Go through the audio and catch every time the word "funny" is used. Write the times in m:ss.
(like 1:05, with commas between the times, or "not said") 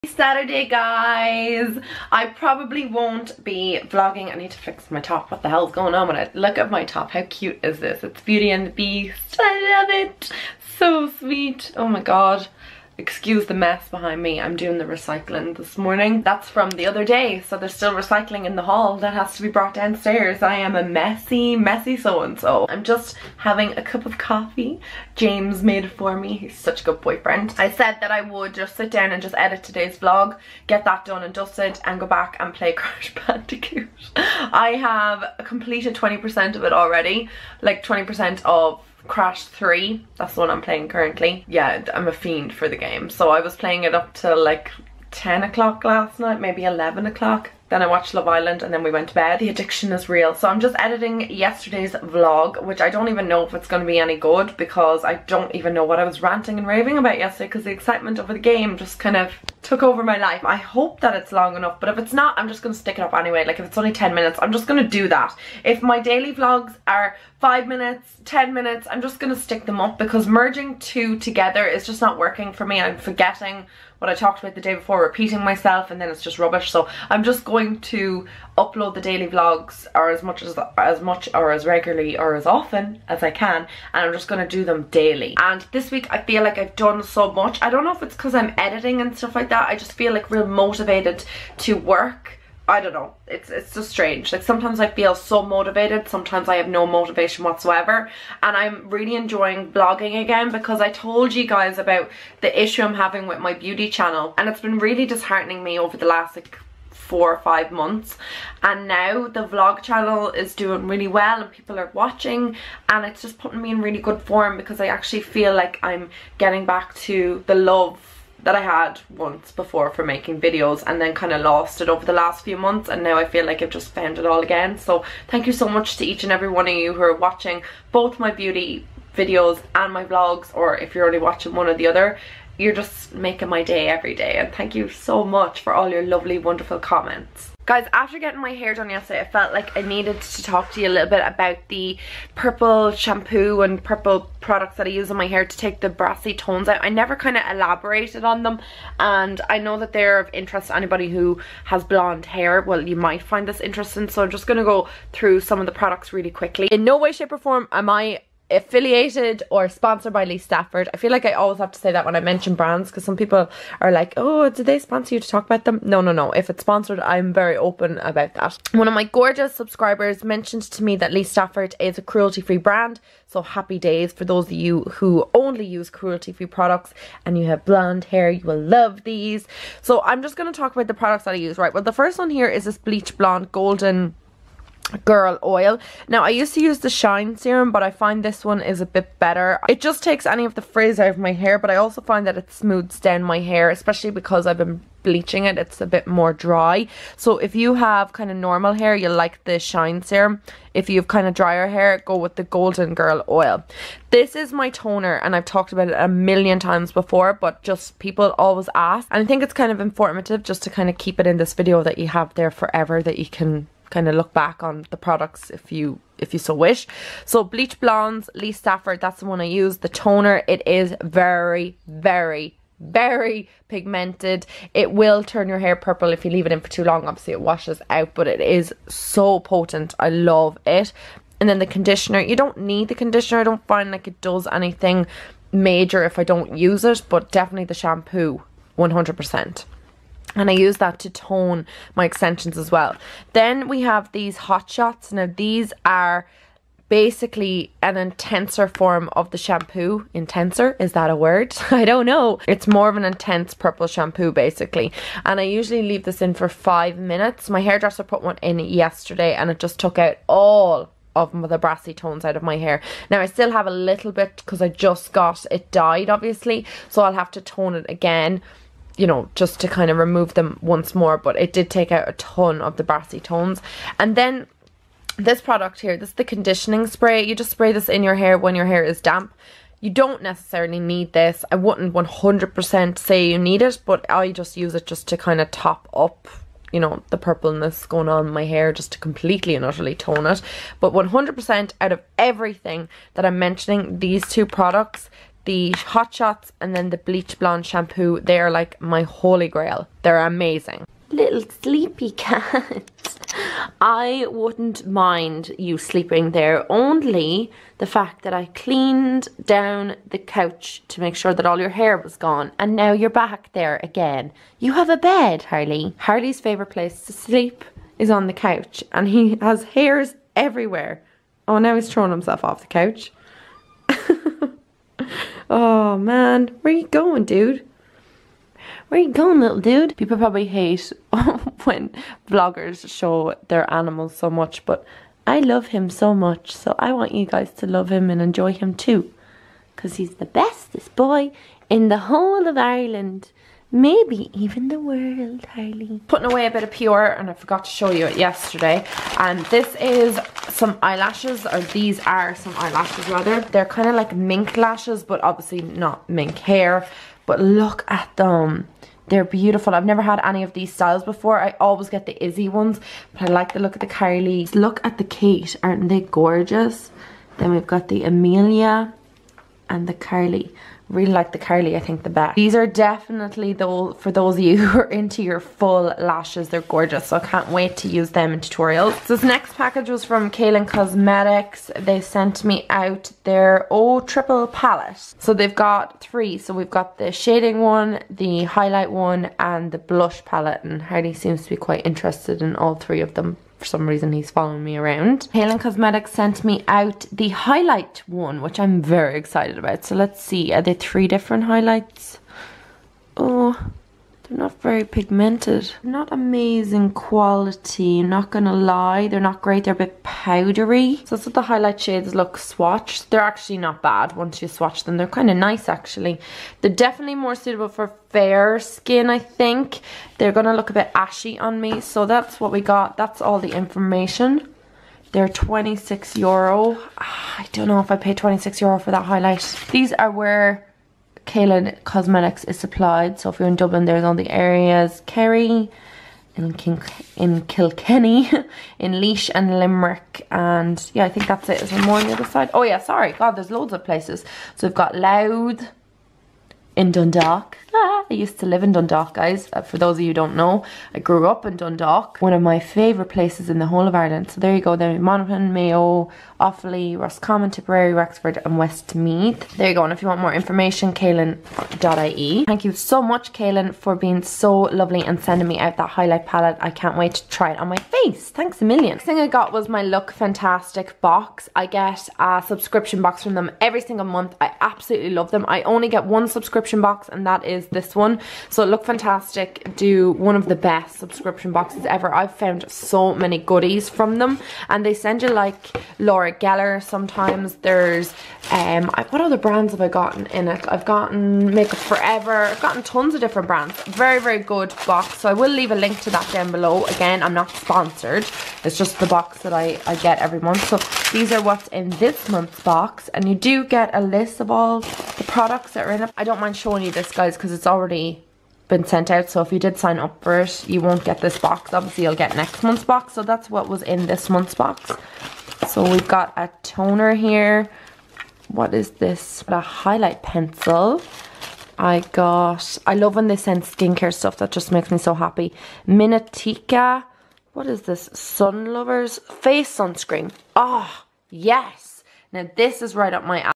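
not said.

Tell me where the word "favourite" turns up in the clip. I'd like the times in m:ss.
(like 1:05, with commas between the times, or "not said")
5:16, 7:32.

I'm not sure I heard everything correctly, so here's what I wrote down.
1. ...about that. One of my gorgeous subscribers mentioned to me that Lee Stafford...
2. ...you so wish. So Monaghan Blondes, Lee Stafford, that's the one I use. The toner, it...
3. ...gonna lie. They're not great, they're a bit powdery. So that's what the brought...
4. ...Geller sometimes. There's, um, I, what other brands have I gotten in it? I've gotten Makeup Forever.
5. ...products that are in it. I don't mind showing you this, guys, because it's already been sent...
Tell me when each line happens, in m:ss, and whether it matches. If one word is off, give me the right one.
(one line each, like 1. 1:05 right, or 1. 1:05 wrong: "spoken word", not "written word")
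1. 2:47 right
2. 3:36 wrong: "Bleach", not "Monaghan"
3. 6:48 wrong: "highlight", not "brought"
4. 8:06 right
5. 8:25 right.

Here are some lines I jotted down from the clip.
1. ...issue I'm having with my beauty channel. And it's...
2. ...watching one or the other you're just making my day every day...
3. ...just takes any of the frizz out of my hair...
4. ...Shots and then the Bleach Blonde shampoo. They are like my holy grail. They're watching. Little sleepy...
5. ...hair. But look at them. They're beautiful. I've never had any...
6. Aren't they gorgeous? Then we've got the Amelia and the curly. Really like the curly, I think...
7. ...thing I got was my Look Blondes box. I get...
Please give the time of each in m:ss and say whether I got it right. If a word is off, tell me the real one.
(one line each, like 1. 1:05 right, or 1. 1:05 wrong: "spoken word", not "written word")
1. 1:42 right
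2. 2:11 right
3. 3:09 right
4. 4:56 wrong: "amazing", not "watching"
5. 5:56 right
6. 6:05 right
7. 7:49 wrong: "Fantastic", not "Blondes".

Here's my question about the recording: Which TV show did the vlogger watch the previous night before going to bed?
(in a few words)
Love Island.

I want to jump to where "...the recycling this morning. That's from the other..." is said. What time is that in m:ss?
0:14.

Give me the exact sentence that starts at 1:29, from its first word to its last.
I just feel like real motivated to work I don't know.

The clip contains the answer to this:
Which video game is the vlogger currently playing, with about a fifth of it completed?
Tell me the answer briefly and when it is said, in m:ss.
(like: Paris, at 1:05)
Crash 3, at 0:39.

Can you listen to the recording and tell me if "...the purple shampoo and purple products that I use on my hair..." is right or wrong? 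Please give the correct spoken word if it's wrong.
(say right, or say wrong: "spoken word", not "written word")
right.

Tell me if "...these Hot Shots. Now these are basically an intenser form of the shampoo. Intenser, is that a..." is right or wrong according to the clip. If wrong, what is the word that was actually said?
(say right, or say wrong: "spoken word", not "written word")
right.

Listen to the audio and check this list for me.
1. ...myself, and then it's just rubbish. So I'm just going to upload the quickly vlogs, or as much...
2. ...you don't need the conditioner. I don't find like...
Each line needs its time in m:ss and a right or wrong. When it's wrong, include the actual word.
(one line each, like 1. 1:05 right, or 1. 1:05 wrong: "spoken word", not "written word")
1. 1:15 wrong: "daily", not "quickly"
2. 3:52 right.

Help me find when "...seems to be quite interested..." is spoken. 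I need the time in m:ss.
6:31.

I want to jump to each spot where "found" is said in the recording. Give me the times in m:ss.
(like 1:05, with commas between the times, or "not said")
2:03, 8:02.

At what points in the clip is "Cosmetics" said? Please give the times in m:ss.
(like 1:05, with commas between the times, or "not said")
6:20, 6:35, 7:11.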